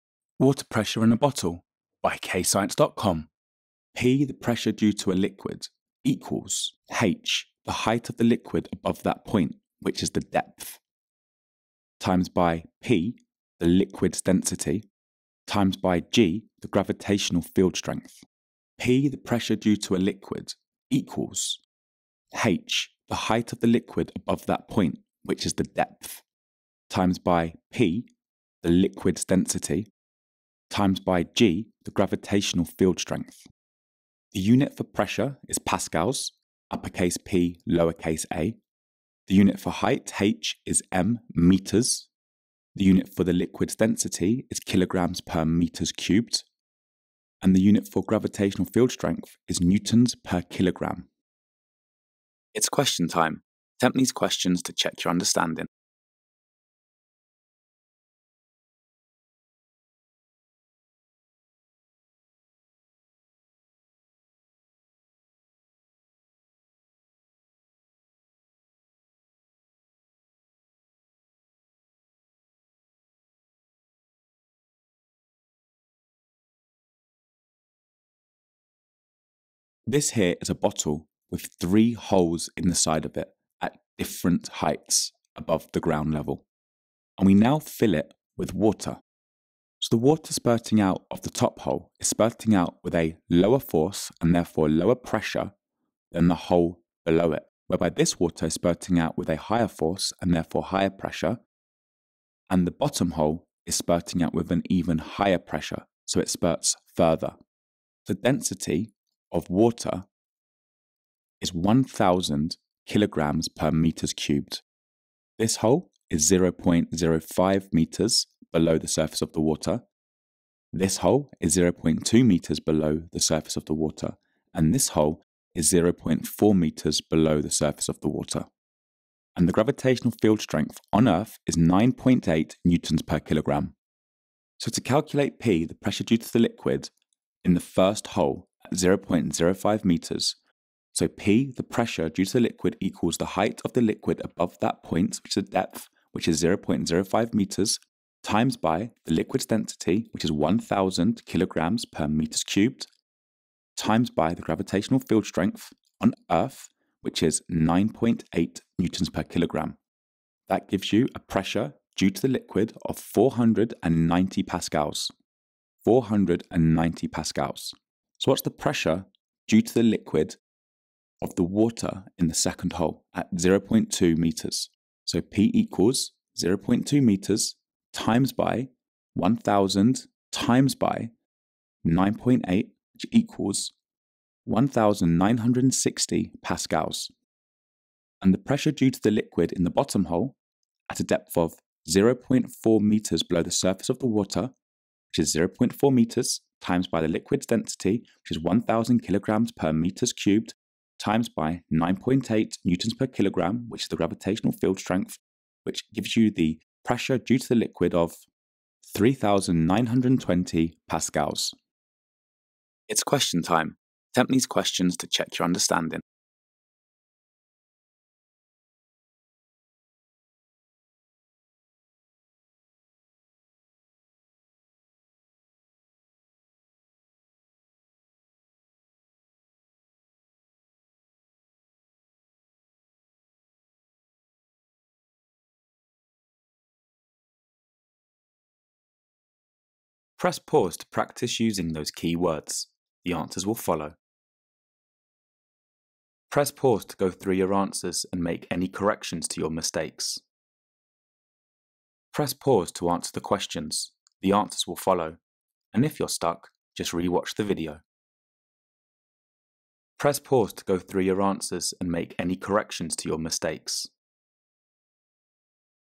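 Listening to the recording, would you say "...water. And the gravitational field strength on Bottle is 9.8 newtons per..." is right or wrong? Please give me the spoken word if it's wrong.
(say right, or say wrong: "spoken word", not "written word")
wrong: "Earth", not "Bottle".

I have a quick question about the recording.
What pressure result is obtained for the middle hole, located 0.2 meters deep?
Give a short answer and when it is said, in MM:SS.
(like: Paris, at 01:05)
1960 pascals, at 03:04.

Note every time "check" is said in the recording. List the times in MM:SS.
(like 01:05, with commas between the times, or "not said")
00:54, 03:35.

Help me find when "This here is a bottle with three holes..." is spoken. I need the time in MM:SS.
01:19.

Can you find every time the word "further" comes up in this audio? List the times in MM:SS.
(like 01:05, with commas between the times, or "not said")
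01:46.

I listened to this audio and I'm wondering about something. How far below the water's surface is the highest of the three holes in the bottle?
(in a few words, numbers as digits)
0.05 meters.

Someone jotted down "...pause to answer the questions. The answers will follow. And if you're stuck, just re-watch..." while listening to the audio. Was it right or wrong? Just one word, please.
right.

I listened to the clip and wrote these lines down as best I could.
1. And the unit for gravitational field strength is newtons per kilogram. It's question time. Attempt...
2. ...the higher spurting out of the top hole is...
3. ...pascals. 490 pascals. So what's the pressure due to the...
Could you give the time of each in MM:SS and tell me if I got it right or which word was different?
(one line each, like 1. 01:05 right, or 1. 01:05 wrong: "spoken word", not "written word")
1. 00:47 right
2. 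01:29 wrong: "water", not "higher"
3. 02:44 right.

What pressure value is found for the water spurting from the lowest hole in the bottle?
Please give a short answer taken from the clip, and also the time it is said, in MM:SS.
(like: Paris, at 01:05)
3,920 pascals, at 03:28.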